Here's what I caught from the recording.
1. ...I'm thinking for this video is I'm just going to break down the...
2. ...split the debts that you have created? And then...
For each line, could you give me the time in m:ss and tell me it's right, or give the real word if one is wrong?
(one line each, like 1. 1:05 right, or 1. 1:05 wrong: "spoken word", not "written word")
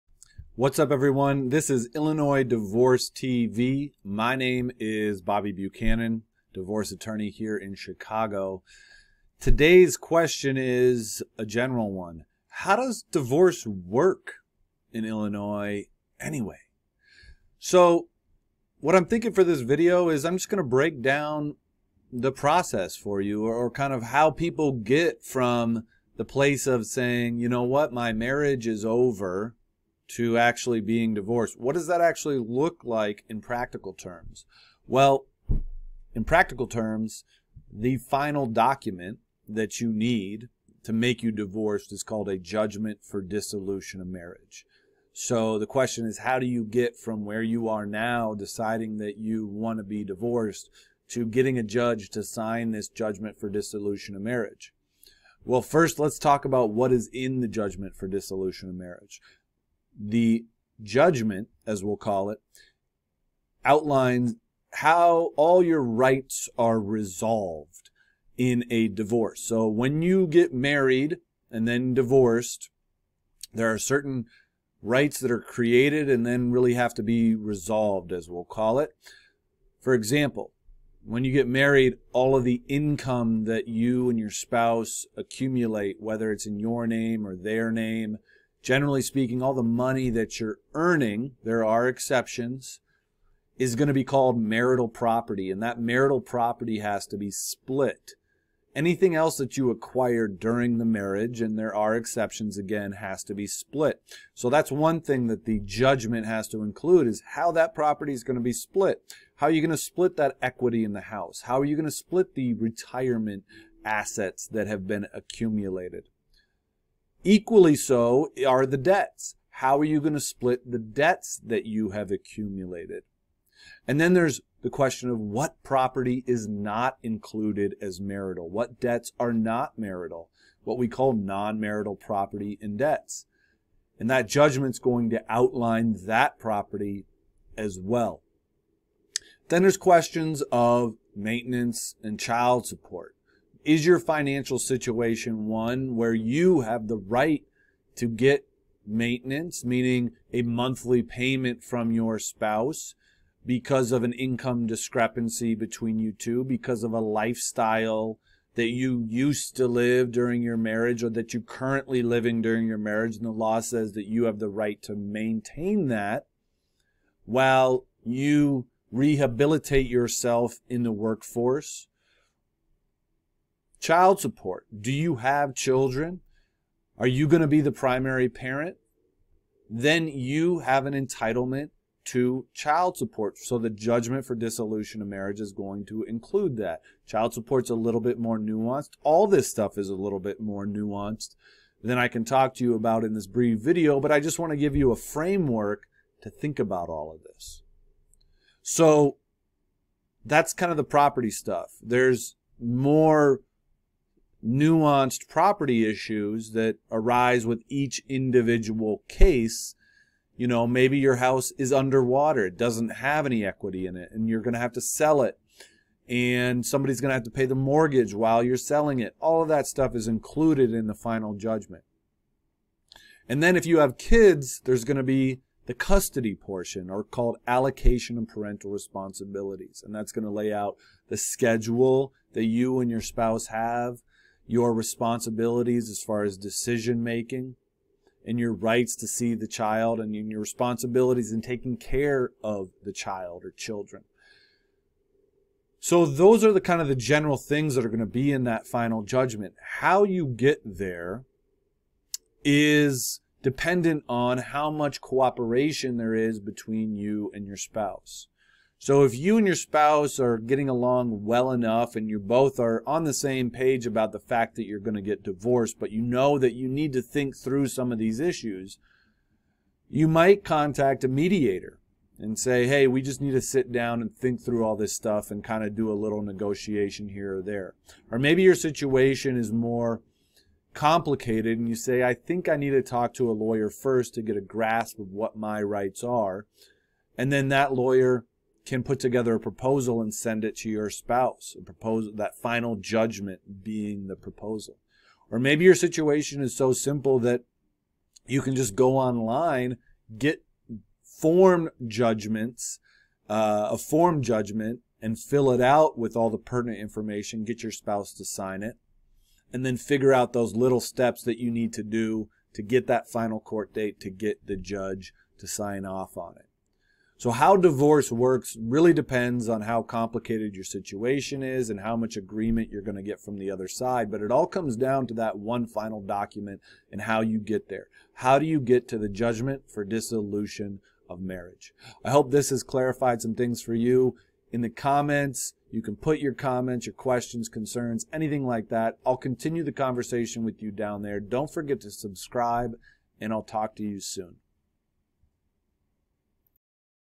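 1. 0:18 right
2. 2:00 wrong: "accumulated", not "created".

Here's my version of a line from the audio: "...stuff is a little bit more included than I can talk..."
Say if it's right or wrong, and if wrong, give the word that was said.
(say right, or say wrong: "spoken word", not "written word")
wrong: "nuanced", not "included".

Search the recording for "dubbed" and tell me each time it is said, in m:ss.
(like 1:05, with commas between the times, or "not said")
not said.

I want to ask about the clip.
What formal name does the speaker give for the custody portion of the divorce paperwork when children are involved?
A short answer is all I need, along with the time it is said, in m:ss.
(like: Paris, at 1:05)
Allocation and parental responsibilities, at 3:47.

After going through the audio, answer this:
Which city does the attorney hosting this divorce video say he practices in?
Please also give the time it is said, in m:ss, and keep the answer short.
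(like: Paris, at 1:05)
Chicago, at 0:07.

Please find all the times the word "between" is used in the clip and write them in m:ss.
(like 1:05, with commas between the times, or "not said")
2:35, 4:16.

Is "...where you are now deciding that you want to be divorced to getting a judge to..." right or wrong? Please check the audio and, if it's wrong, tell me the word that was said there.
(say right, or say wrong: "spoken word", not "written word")
right.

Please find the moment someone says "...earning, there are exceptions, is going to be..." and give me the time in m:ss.
1:30.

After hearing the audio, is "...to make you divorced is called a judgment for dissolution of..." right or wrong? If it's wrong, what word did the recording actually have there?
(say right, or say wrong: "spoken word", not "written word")
right.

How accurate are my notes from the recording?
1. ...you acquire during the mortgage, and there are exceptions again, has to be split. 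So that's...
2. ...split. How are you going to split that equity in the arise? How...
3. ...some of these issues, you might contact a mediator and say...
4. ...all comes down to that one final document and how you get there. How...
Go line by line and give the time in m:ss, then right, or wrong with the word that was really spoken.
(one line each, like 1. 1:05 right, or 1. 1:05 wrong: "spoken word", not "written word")
1. 1:39 wrong: "marriage", not "mortgage"
2. 1:48 wrong: "house", not "arise"
3. 4:27 right
4. 5:24 right.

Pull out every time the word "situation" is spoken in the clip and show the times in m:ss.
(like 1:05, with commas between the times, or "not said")
2:24, 4:38, 4:55, 5:20.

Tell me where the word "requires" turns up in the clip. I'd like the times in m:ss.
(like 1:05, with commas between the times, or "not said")
not said.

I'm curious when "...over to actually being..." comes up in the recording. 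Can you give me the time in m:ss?
0:28.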